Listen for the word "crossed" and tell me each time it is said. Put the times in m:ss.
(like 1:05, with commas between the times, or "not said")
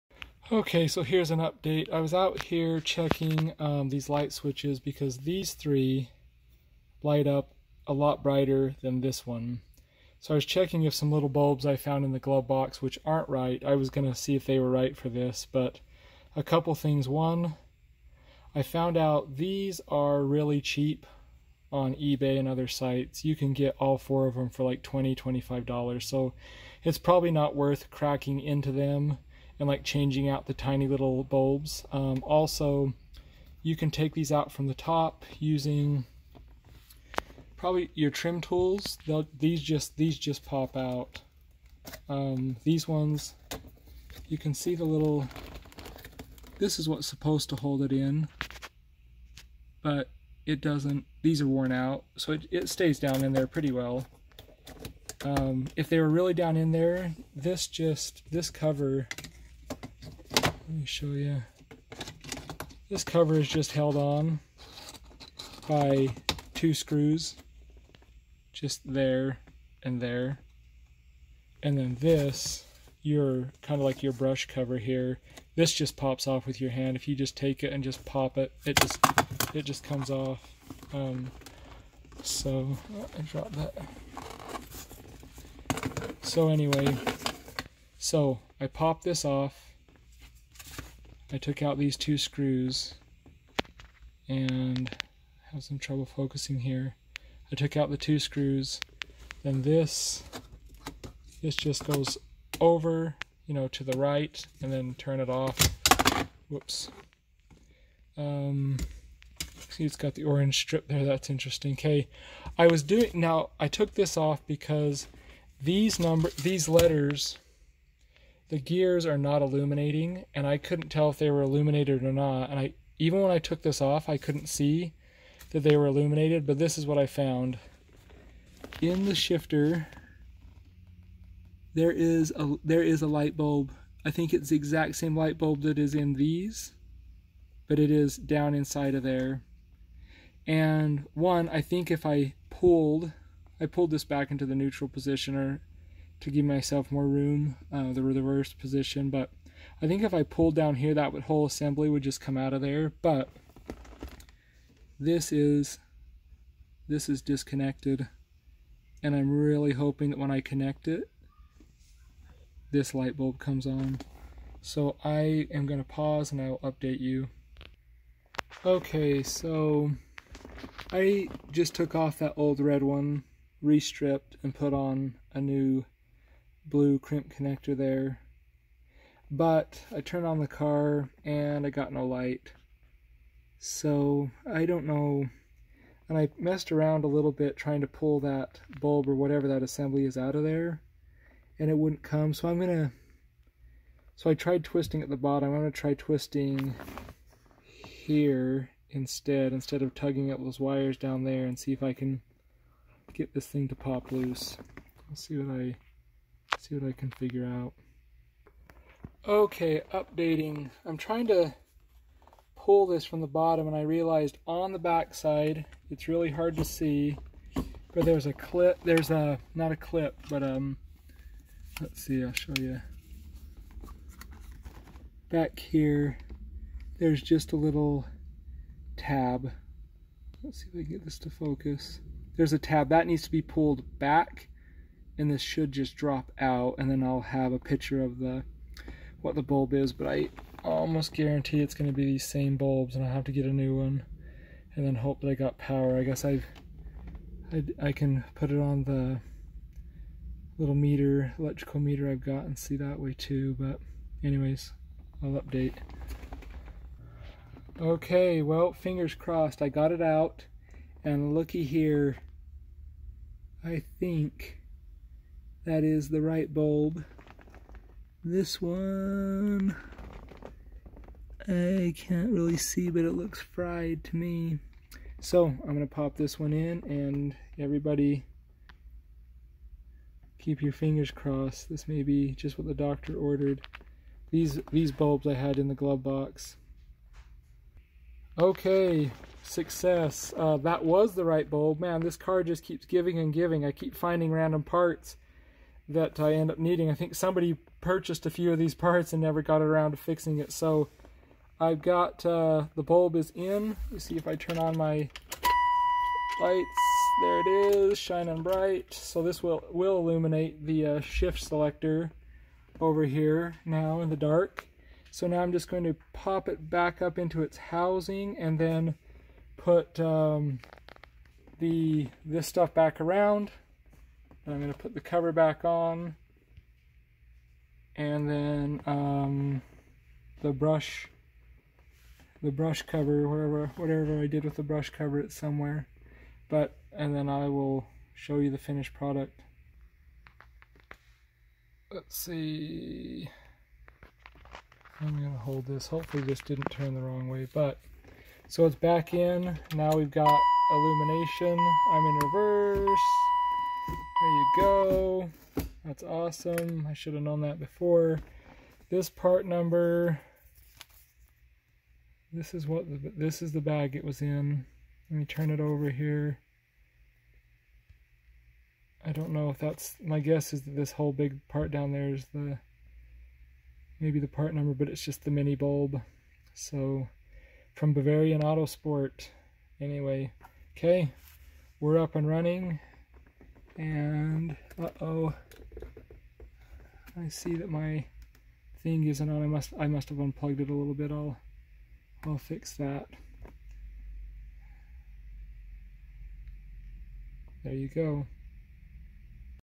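4:19, 4:41.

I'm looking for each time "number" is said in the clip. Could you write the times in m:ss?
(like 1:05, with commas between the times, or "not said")
1:55, 5:59, 6:14.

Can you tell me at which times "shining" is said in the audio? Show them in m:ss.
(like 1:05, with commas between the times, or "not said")
5:07.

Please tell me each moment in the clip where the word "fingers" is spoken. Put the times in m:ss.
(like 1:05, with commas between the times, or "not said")
4:18, 4:40.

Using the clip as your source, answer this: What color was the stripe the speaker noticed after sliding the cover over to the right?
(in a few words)
Orange.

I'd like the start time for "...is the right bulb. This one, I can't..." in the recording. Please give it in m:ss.
4:25.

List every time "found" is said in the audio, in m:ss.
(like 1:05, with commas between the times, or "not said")
0:11, 0:18, 2:07.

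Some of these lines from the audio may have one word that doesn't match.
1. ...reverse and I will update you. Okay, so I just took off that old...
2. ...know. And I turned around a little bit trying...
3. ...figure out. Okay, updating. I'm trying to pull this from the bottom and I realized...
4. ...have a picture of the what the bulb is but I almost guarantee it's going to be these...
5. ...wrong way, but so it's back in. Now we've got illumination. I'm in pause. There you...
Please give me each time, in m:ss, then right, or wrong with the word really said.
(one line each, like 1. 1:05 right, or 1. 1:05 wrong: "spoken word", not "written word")
1. 2:45 wrong: "pause", not "reverse"
2. 3:04 wrong: "messed", not "turned"
3. 3:27 right
4. 3:57 right
5. 5:47 wrong: "reverse", not "pause".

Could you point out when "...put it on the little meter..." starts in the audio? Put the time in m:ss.
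4:08.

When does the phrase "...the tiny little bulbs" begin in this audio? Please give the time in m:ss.
0:30.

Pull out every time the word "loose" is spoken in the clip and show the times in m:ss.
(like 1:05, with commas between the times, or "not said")
3:24.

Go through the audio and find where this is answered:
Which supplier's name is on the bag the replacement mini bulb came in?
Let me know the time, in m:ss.
6:17.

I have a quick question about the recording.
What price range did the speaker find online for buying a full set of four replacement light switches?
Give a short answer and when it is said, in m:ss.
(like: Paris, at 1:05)
$20-$25, at 0:24.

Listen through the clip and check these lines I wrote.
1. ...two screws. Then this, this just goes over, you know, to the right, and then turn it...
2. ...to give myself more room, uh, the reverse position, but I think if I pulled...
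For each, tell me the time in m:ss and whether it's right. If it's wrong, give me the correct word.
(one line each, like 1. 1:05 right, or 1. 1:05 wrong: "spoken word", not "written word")
1. 1:37 right
2. 2:26 right.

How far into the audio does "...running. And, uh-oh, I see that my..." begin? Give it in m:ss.
6:22.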